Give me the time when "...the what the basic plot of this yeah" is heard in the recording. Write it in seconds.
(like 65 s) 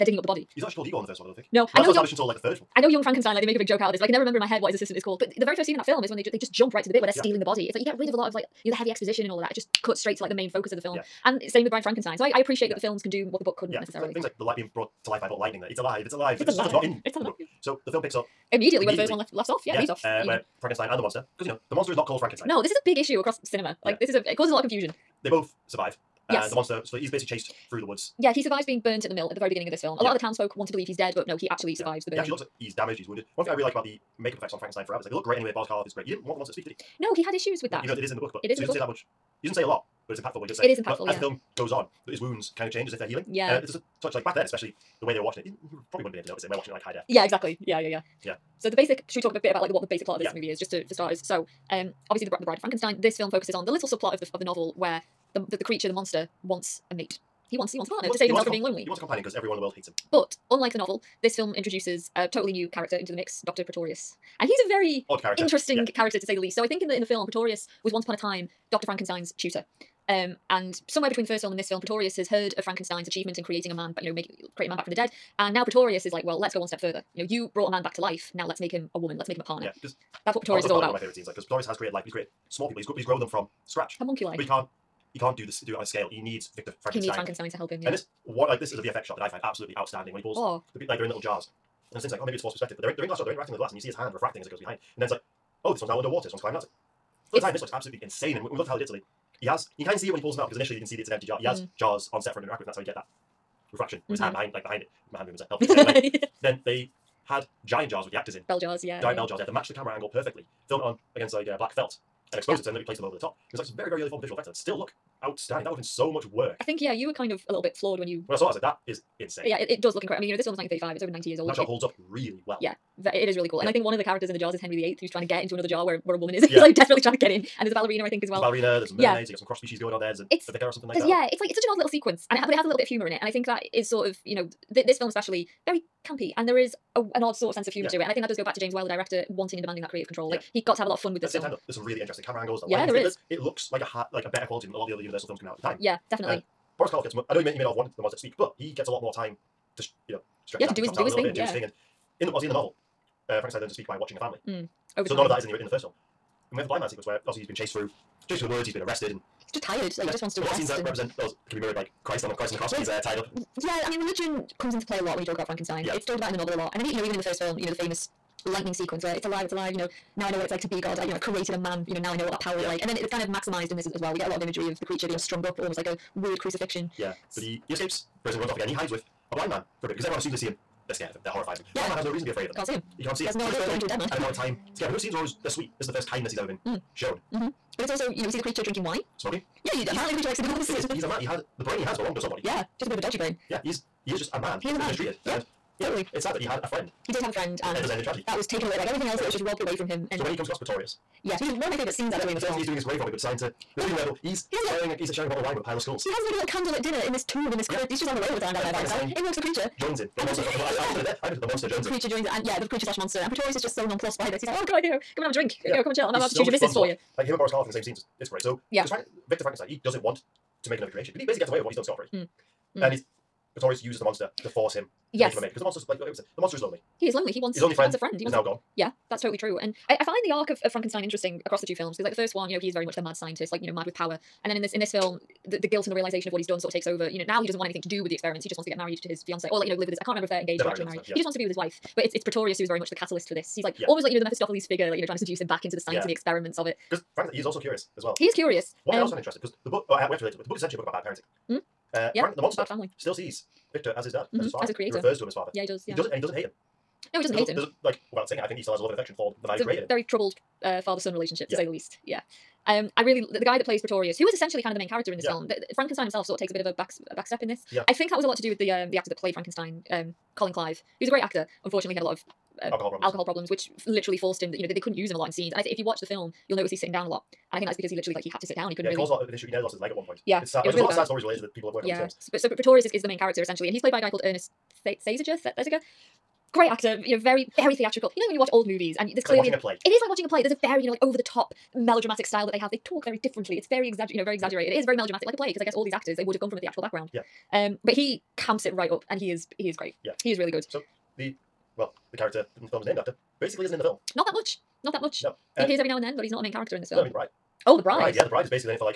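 49 s.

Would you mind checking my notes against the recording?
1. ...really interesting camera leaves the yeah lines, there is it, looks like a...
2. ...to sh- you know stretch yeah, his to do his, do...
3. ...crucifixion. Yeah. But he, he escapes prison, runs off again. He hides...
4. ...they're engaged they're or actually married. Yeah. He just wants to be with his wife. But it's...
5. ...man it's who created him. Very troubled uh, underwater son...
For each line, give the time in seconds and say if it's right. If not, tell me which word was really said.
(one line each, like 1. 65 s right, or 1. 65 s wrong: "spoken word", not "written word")
1. 141 s wrong: "angles", not "leaves"
2. 149 s right
3. 176 s right
4. 240 s right
5. 259 s wrong: "father", not "underwater".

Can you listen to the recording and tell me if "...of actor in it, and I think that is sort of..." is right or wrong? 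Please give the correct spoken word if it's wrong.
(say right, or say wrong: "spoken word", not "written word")
wrong: "humor", not "actor".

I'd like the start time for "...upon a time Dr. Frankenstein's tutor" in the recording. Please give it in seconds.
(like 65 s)
68 s.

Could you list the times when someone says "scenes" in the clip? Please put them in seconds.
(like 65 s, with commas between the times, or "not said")
5 s, 81 s, 160 s, 185 s, 201 s, 217 s, 275 s.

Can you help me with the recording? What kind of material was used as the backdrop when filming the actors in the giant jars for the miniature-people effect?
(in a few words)
Black felt.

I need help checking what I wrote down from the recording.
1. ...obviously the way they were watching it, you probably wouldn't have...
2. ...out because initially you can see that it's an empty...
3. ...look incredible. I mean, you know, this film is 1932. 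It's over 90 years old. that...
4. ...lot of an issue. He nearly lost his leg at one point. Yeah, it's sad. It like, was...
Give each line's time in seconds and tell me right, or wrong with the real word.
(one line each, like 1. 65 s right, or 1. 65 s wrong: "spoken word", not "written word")
1. 44 s wrong: "especially", not "obviously"
2. 100 s right
3. 119 s wrong: "1935", not "1932"
4. 279 s right.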